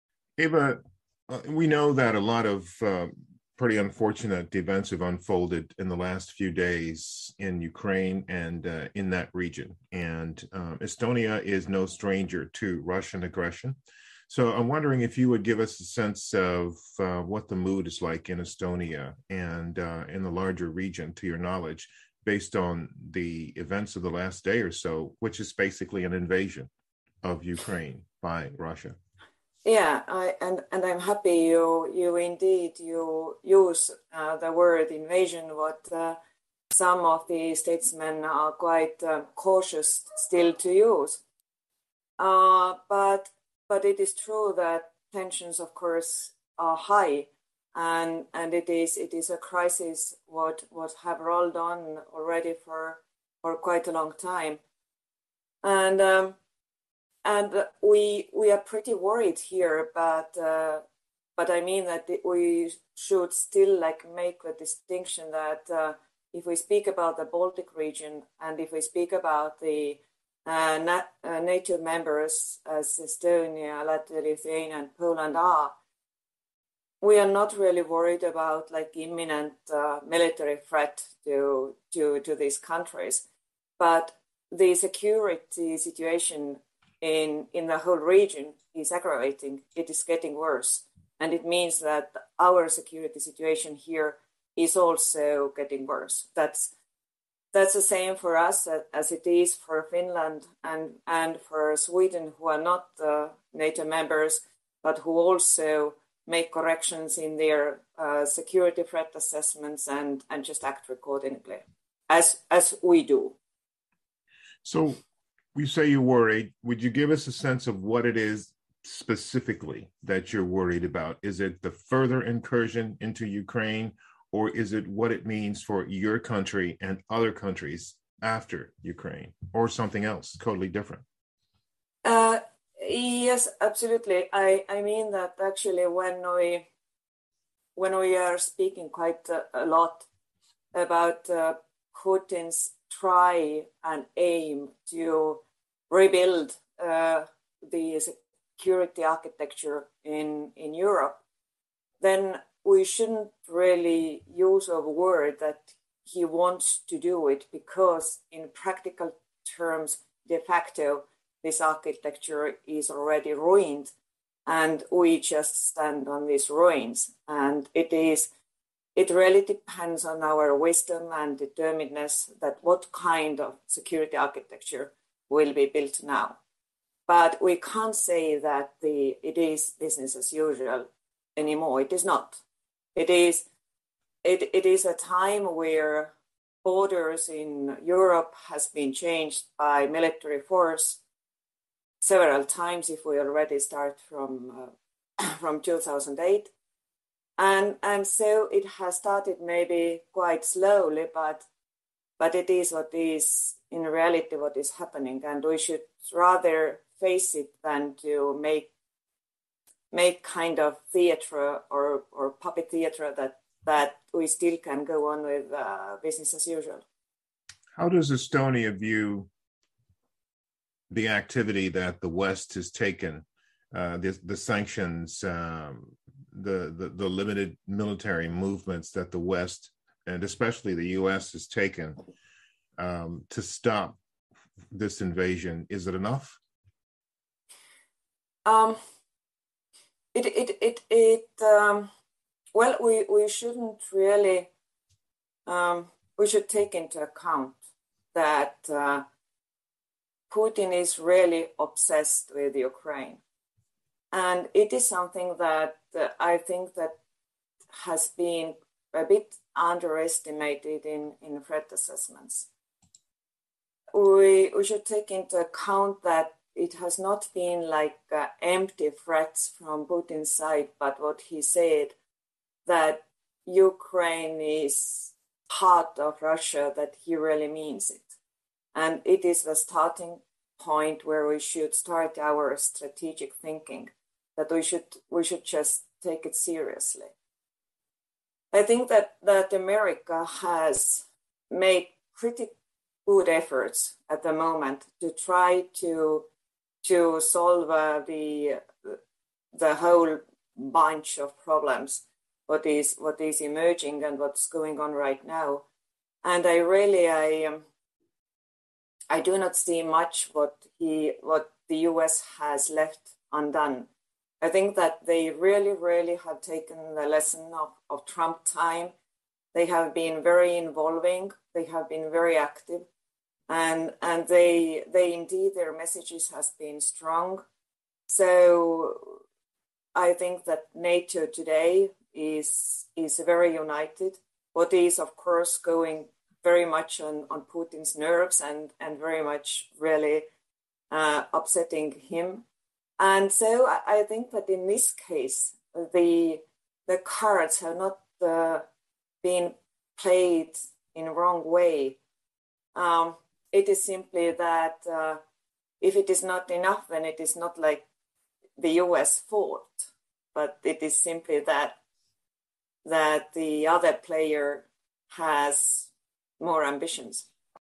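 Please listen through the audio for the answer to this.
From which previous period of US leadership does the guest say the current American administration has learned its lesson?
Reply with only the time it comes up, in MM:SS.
05:18.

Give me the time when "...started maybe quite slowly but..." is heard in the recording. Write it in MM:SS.
03:18.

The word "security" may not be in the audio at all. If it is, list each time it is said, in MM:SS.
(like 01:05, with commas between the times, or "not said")
01:24, 01:32, 01:48, 02:28, 02:53.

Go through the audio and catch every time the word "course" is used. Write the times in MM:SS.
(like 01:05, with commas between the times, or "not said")
00:45, 05:35.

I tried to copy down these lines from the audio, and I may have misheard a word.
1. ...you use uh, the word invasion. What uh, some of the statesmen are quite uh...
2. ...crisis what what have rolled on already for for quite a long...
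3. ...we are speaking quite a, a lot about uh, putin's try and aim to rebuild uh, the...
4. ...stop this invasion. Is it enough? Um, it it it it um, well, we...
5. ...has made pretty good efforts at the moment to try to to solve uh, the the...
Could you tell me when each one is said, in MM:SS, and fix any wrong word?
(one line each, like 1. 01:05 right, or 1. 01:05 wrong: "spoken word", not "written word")
1. 00:32 right
2. 00:49 right
3. 02:17 right
4. 03:53 right
5. 04:50 right.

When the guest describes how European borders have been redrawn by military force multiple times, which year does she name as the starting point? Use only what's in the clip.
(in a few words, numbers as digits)
2008.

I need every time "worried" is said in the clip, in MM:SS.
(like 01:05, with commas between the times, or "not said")
00:58, 01:17, 01:56, 02:00.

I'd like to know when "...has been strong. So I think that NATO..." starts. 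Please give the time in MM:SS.
05:26.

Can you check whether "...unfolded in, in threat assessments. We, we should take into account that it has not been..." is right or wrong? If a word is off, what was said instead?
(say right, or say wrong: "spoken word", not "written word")
wrong: "underestimated", not "unfolded".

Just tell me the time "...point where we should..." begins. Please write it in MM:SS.
04:40.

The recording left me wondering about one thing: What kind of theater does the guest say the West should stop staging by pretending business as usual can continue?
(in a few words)
puppet theater.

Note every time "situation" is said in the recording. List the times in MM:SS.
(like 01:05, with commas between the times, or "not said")
01:25, 01:33.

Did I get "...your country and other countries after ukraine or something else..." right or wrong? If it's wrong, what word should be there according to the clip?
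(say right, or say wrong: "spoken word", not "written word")
right.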